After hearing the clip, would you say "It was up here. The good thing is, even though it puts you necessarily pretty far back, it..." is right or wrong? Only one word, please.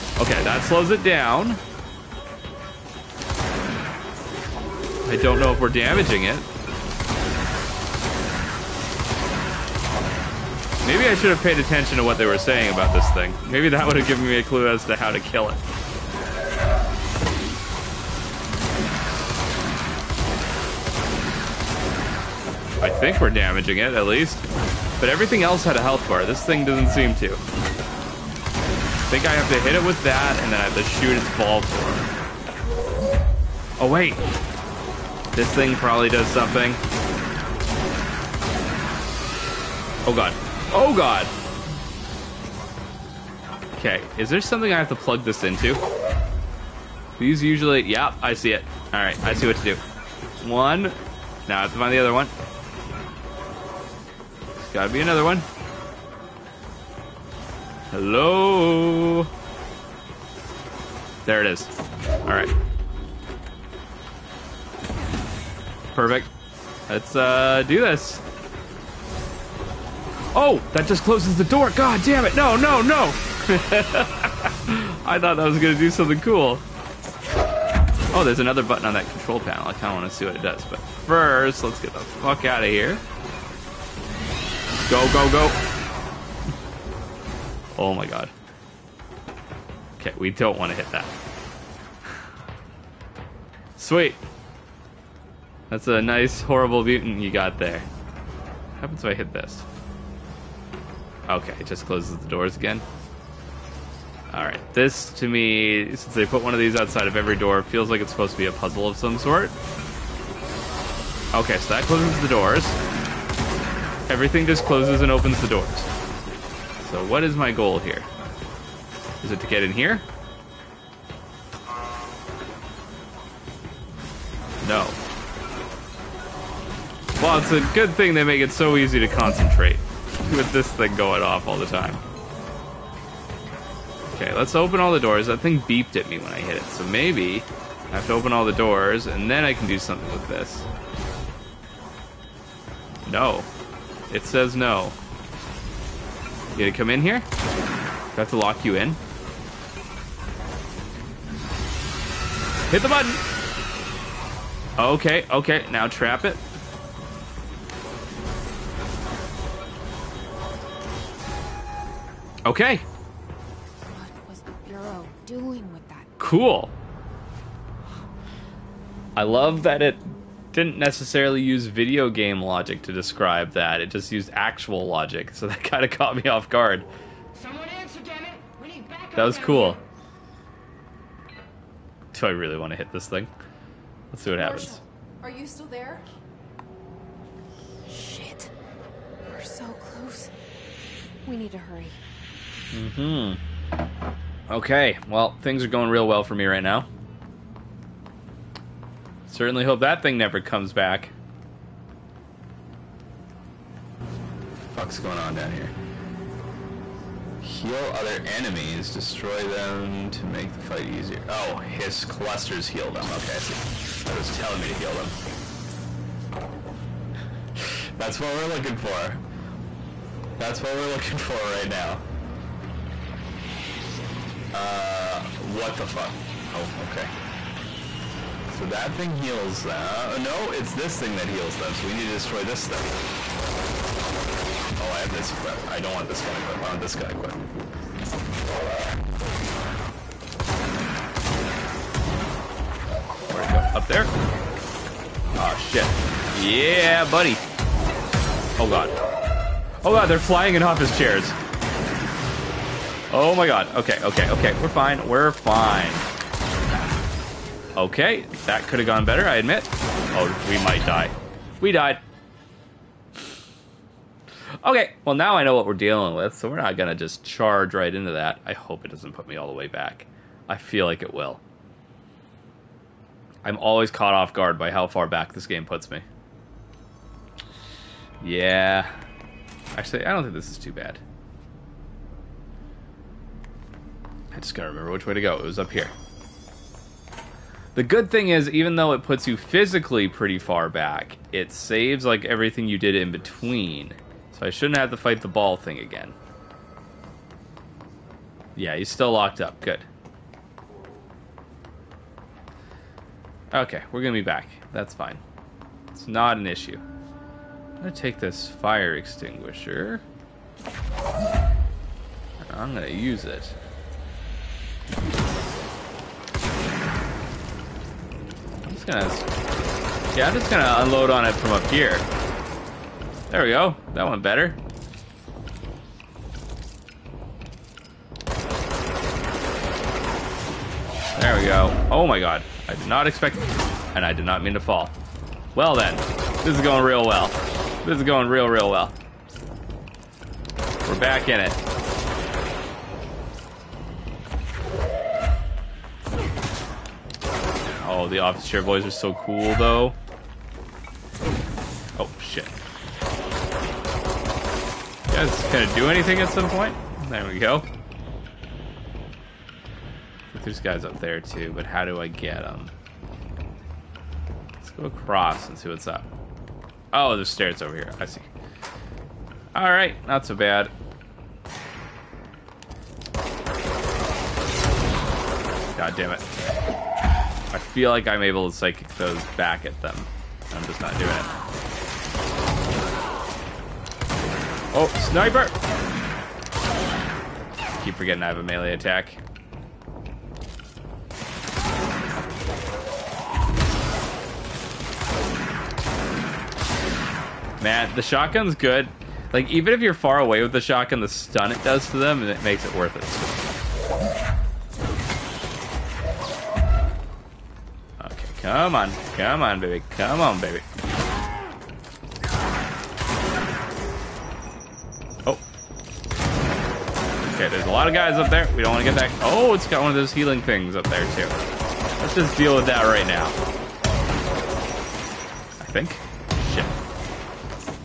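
wrong.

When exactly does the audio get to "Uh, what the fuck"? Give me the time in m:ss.
3:44.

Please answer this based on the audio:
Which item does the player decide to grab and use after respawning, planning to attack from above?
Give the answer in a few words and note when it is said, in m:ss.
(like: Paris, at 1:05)
Fire extinguisher, at 5:08.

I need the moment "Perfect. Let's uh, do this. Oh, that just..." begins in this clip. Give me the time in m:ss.
1:05.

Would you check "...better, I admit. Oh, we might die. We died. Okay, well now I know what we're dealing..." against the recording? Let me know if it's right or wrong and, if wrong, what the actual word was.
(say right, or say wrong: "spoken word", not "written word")
right.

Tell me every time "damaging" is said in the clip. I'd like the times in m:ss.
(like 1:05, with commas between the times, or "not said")
0:05, 0:23.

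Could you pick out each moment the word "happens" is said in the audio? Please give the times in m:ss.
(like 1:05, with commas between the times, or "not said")
1:38, 3:04.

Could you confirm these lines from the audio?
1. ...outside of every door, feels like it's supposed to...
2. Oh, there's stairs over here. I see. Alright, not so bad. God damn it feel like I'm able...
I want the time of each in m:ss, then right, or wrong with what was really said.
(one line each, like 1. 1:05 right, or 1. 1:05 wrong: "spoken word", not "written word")
1. 1:46 right
2. 6:06 right.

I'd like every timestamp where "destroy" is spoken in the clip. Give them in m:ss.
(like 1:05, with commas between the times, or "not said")
3:28, 3:52.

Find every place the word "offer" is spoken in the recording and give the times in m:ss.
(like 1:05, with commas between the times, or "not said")
not said.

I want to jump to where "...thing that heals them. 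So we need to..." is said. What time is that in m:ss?
3:50.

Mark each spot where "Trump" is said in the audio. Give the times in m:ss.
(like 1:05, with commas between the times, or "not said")
not said.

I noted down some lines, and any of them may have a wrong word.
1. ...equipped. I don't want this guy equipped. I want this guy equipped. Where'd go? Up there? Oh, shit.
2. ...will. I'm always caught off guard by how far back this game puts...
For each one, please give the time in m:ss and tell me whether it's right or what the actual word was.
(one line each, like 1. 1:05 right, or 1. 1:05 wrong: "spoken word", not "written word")
1. 3:55 right
2. 4:31 right.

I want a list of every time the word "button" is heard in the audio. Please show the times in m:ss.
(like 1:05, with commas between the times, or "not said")
1:18, 2:32.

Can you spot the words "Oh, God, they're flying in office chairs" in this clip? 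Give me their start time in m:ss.
4:09.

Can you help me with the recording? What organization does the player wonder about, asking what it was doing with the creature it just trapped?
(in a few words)
The Bureau.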